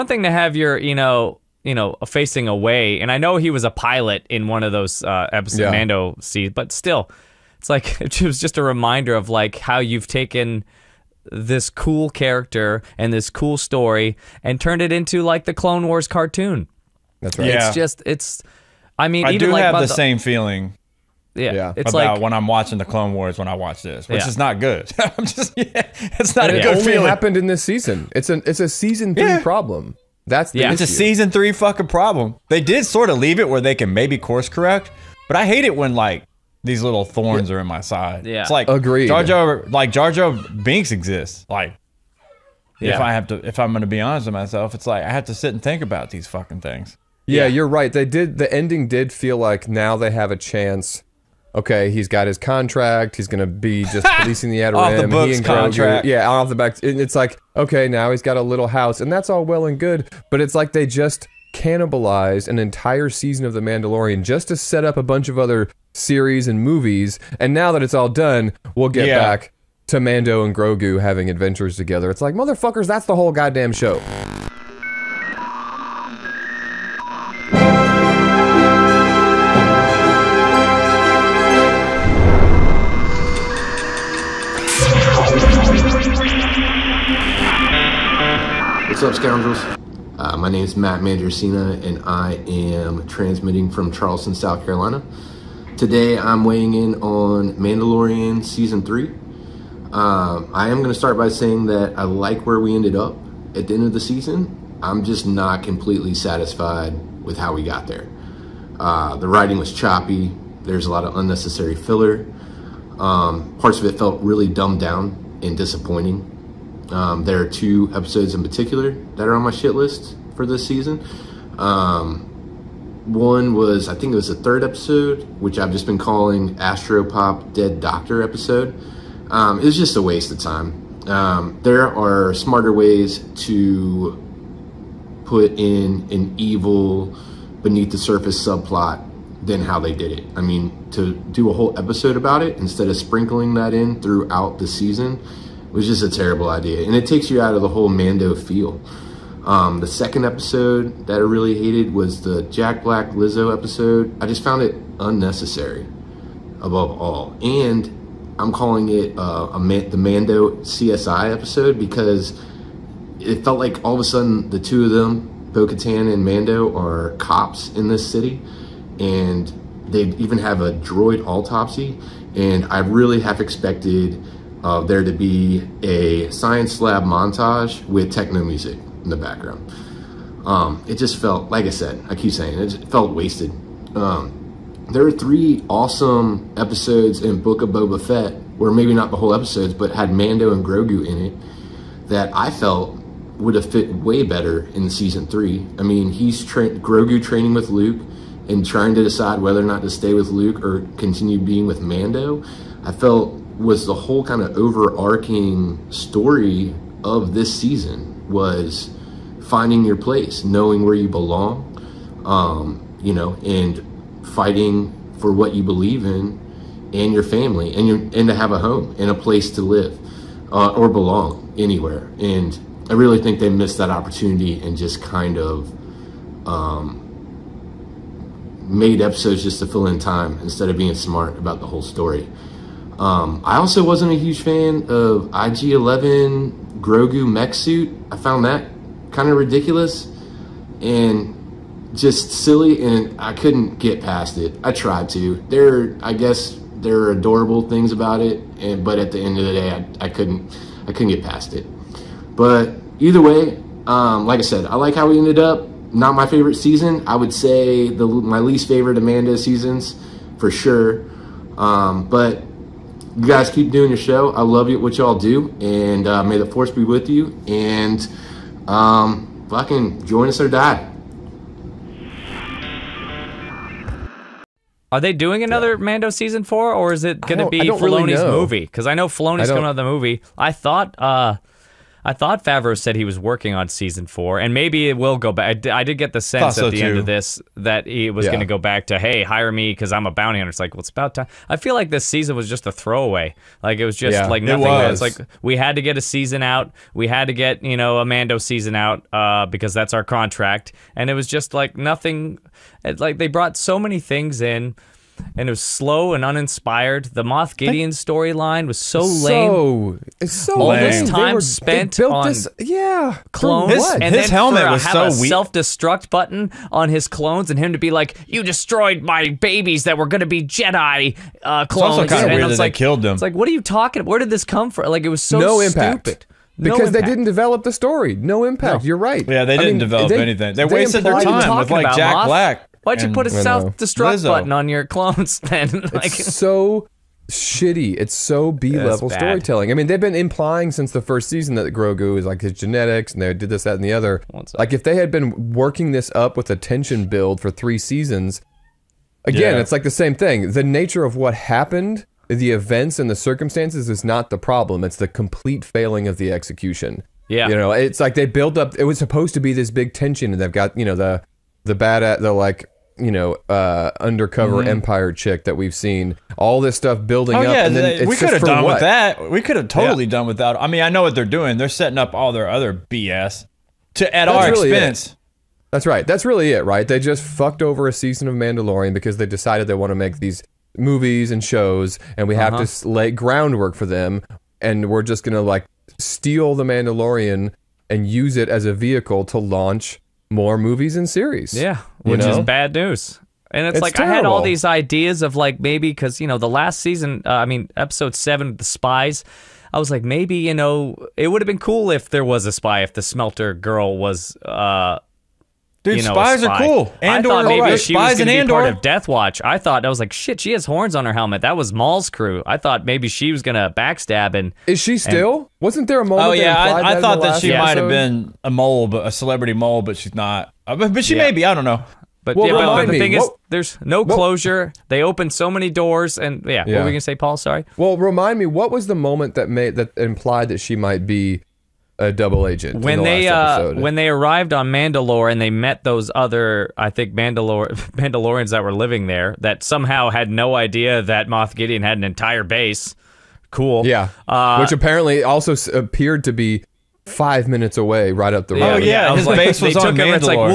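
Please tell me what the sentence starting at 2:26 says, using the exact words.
And it takes you out of the whole Mando feel.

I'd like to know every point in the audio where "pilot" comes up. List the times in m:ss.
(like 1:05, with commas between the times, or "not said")
0:03.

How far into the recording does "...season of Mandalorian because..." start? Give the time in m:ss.
6:17.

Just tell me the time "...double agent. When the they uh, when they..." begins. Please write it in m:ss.
7:12.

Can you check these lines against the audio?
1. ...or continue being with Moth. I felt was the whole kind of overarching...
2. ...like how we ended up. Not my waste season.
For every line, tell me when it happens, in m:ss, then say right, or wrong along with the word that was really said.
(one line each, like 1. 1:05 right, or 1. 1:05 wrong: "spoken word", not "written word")
1. 3:20 wrong: "Mando", not "Moth"
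2. 4:14 wrong: "favorite", not "waste".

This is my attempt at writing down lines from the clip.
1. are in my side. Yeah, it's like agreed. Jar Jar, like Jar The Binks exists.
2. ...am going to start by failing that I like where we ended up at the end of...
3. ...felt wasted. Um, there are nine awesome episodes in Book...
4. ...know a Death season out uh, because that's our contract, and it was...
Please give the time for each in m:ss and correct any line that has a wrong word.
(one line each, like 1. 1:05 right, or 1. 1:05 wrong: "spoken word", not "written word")
1. 0:37 wrong: "Jar", not "The"
2. 1:40 wrong: "saying", not "failing"
3. 3:02 wrong: "three", not "nine"
4. 4:57 wrong: "Mando", not "Death".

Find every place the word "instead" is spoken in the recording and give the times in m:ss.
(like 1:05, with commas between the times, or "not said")
2:22, 3:50.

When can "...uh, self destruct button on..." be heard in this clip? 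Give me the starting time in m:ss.
5:33.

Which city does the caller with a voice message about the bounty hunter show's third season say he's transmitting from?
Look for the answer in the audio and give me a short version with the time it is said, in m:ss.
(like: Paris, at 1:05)
Charleston, South Carolina, at 1:33.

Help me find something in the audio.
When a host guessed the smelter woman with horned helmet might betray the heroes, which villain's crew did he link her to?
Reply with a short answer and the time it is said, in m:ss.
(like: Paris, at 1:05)
Maul, at 6:51.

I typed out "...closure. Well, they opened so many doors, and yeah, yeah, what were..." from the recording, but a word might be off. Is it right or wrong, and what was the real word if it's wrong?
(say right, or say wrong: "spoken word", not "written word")
right.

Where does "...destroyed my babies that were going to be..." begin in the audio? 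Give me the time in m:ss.
5:18.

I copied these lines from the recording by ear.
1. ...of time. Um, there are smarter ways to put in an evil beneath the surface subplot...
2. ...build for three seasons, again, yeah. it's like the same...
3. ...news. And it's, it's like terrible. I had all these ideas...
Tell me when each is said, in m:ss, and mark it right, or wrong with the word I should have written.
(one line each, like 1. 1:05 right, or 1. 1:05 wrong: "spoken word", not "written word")
1. 2:10 right
2. 5:47 right
3. 6:32 right.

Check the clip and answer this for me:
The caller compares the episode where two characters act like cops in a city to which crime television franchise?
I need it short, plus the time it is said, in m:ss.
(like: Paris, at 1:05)
CSI, at 2:39.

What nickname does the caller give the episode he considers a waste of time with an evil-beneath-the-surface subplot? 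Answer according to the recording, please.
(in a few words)
Astropop Dead Doctor episode.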